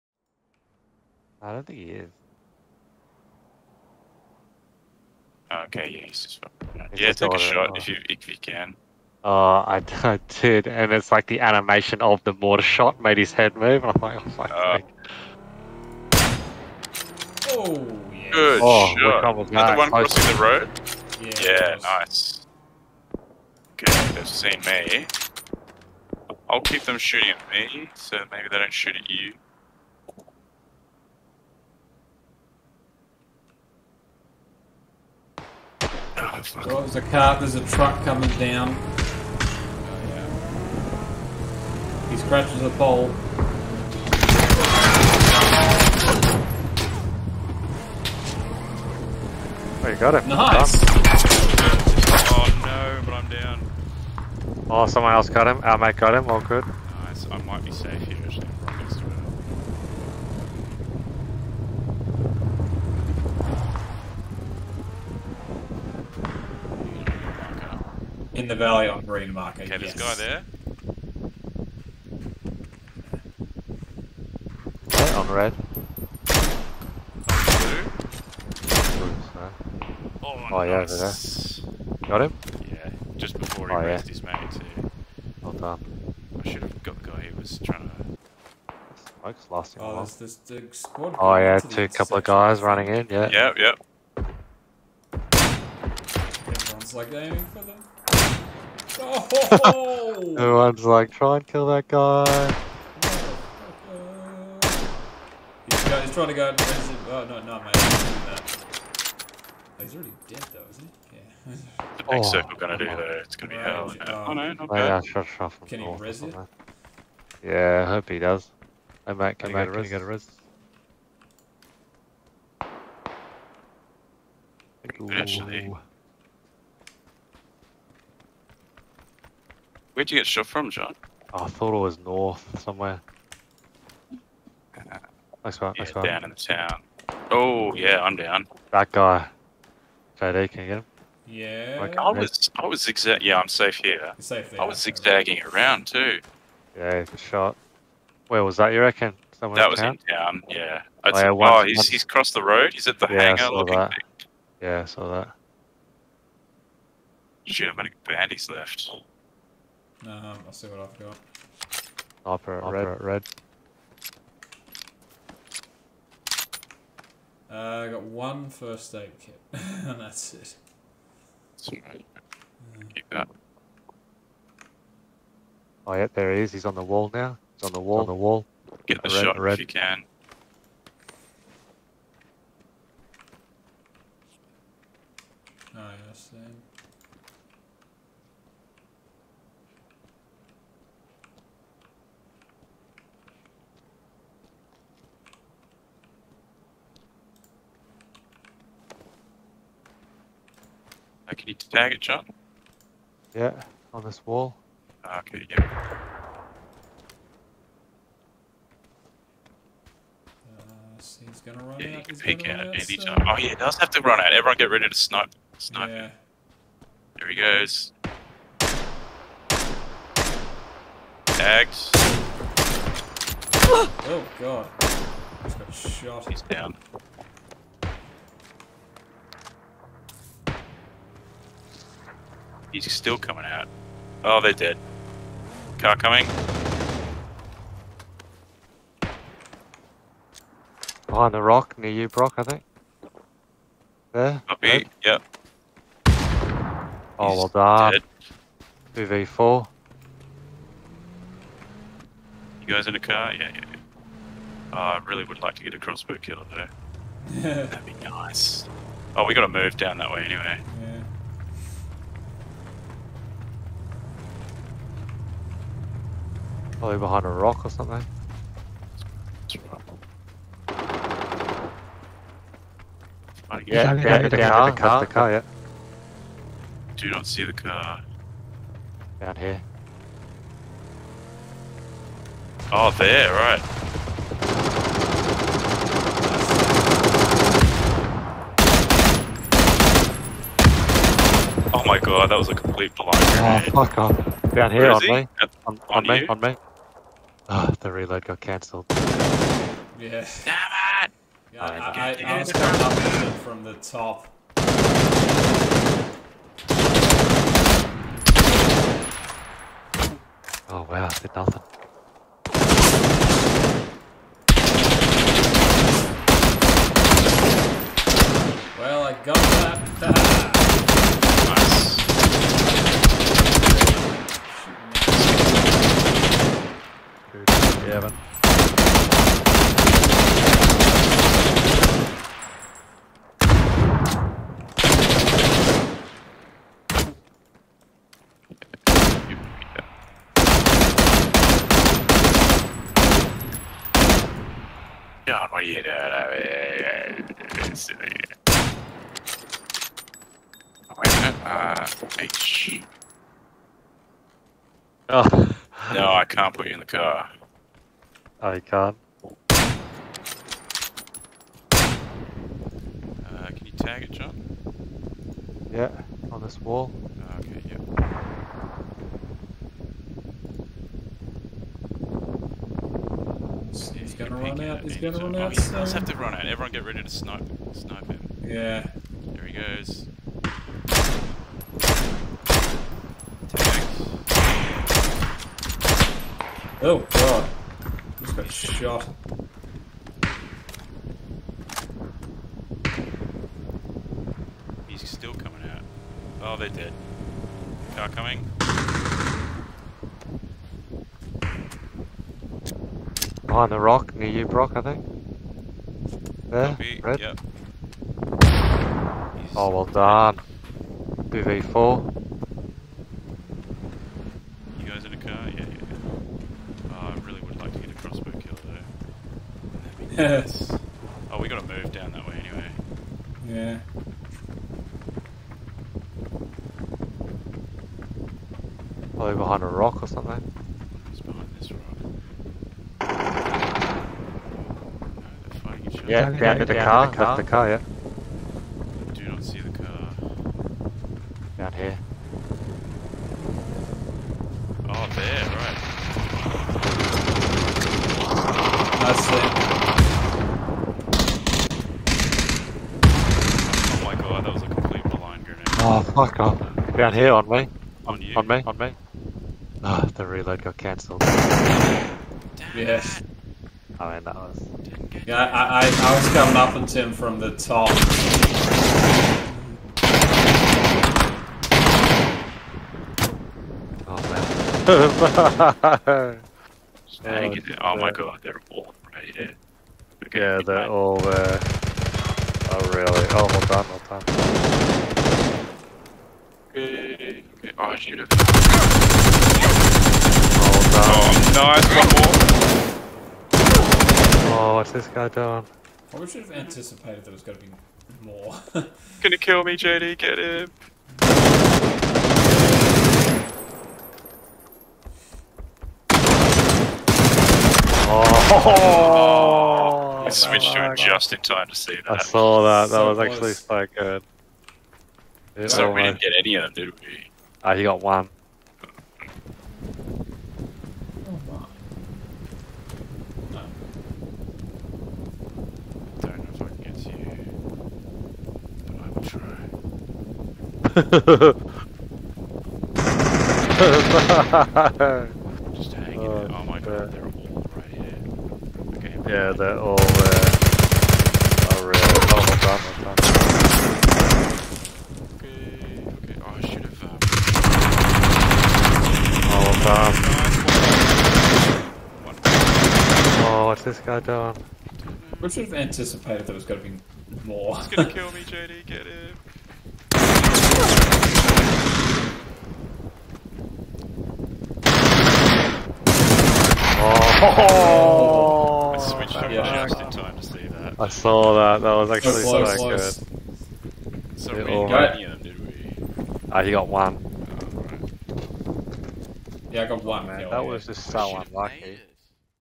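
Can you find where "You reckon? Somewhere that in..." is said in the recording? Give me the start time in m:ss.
2:28.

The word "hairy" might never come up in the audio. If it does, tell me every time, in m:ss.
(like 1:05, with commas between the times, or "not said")
not said.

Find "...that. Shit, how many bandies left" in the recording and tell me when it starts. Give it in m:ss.
2:35.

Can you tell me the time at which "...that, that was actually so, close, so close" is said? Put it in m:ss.
9:31.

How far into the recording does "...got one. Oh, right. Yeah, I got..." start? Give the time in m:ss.
9:36.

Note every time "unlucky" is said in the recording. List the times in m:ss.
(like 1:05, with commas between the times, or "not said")
9:41.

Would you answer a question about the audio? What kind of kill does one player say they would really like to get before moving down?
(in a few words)
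A crossbow kill.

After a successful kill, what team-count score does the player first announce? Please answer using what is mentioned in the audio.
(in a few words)
2v4.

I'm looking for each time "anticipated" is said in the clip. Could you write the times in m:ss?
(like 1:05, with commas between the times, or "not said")
8:16, 9:15.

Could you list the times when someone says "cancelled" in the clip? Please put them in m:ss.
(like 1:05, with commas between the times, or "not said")
4:58, 7:40.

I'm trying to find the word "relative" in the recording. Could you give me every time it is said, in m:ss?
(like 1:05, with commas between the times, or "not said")
not said.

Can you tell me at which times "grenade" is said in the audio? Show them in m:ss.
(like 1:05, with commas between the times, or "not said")
7:35.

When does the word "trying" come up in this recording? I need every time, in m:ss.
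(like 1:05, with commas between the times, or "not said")
1:27, 1:46.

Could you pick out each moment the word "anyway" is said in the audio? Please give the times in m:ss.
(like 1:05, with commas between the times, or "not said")
4:20, 7:02.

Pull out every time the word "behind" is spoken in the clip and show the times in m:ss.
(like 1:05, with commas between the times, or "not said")
4:01, 4:26, 6:43, 7:09.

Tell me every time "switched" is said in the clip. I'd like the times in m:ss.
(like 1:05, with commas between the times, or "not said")
8:30, 9:29.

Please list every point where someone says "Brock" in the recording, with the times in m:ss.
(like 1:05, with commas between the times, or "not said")
4:02, 6:44.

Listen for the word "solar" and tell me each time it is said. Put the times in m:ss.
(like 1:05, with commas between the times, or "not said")
not said.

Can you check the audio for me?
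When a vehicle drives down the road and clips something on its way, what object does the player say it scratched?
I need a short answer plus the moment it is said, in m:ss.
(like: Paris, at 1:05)
A pole, at 0:42.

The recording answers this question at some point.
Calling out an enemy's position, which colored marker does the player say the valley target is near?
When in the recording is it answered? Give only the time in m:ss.
1:08.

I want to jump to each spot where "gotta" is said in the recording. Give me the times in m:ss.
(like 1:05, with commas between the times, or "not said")
4:19, 7:01.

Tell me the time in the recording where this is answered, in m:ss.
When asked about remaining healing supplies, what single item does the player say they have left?
2:47.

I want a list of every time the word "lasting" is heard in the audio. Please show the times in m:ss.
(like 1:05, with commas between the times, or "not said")
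1:29.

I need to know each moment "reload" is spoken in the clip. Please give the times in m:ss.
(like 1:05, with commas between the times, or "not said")
4:57, 7:40.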